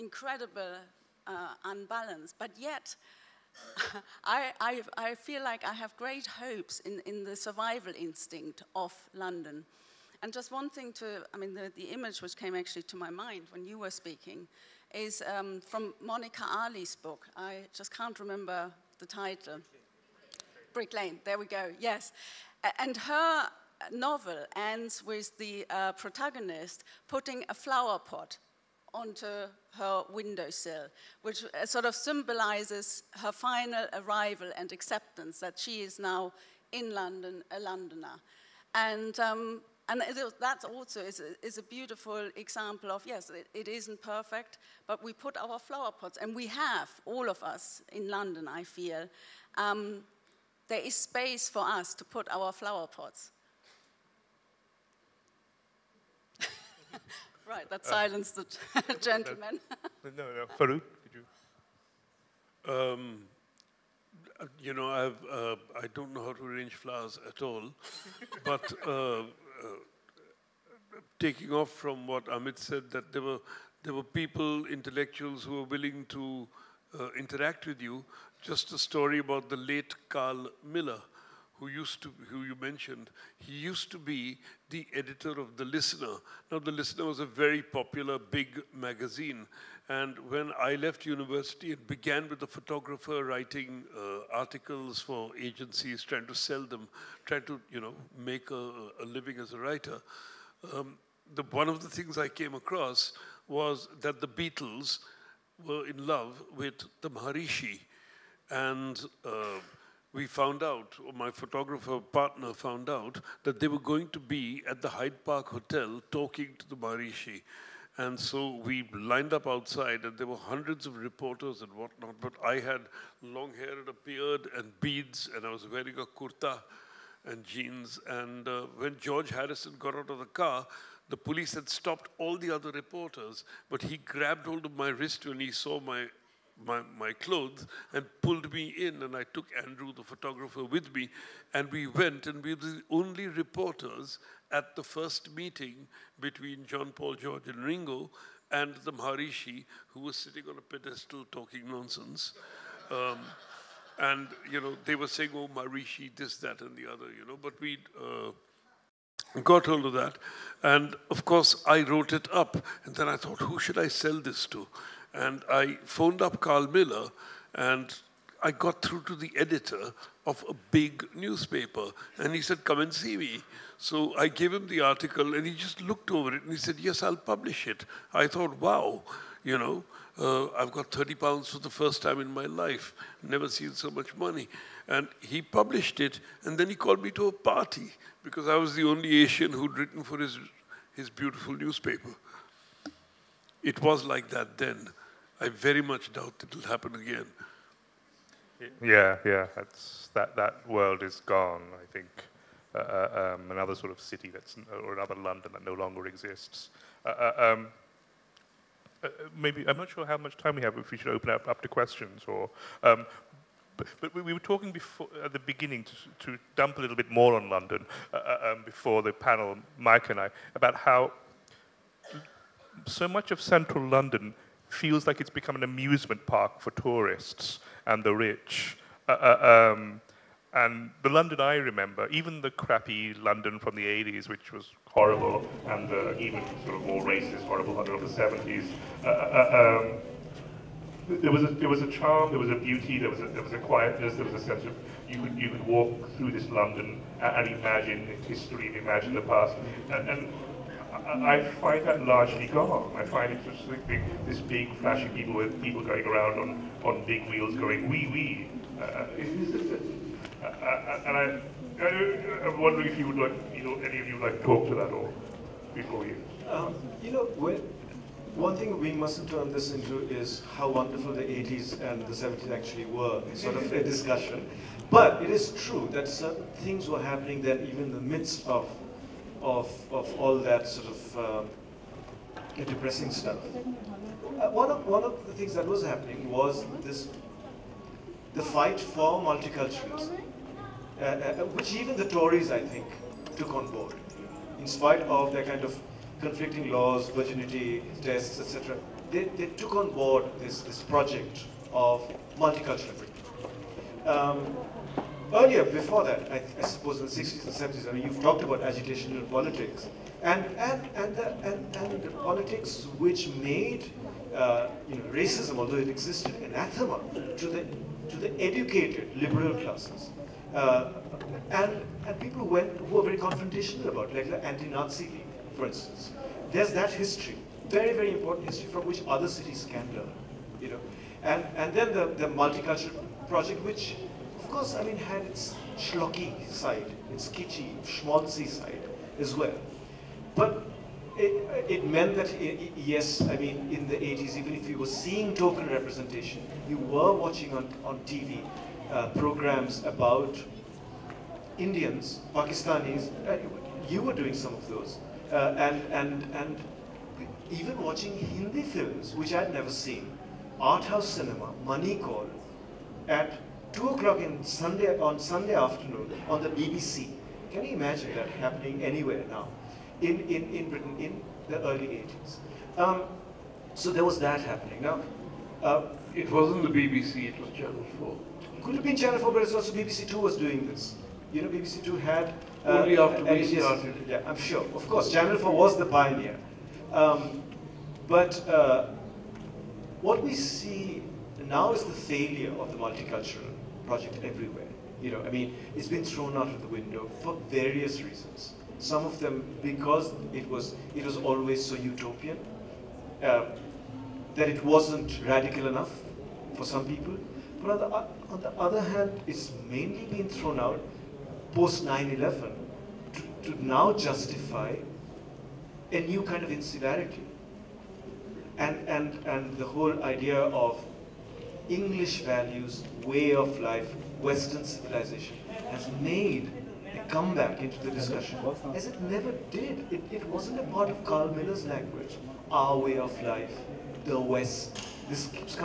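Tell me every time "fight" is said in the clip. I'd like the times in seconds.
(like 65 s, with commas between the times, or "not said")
288 s.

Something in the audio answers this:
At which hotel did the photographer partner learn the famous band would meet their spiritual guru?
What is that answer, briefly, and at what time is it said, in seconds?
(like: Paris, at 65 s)
Hyde Park Hotel, at 114 s.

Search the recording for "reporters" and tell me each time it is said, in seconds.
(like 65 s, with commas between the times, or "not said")
120 s, 132 s, 143 s.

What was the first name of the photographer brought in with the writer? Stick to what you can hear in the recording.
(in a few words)
Andrew.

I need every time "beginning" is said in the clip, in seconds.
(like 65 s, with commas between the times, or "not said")
215 s.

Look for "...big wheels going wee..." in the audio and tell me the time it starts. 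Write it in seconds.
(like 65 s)
257 s.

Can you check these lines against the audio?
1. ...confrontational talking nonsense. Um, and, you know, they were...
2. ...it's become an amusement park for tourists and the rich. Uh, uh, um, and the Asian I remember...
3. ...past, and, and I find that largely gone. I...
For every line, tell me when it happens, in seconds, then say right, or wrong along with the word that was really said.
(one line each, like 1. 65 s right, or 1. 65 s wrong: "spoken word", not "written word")
1. 150 s wrong: "pedestal", not "confrontational"
2. 225 s wrong: "London", not "Asian"
3. 249 s right.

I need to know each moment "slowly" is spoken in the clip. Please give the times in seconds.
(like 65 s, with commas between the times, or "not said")
not said.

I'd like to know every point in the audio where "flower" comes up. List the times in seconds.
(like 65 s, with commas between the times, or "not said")
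27 s, 45 s, 52 s, 66 s.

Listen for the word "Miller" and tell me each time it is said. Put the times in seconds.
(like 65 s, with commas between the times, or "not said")
80 s, 166 s, 431 s.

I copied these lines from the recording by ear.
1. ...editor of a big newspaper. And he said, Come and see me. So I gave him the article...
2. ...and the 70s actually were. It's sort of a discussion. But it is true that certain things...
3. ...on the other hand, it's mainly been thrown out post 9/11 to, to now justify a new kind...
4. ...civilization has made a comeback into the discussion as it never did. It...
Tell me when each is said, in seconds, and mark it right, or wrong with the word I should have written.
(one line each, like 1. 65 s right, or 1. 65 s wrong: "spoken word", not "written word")
1. 169 s right
2. 271 s right
3. 408 s right
4. 424 s right.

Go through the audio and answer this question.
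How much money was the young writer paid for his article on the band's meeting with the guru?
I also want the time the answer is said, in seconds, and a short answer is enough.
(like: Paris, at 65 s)
30 pounds, at 180 s.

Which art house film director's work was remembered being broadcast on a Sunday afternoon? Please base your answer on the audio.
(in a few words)
Mani Kaul.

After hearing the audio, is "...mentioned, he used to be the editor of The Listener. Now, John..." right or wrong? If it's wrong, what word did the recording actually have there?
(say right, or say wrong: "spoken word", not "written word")
wrong: "The", not "John".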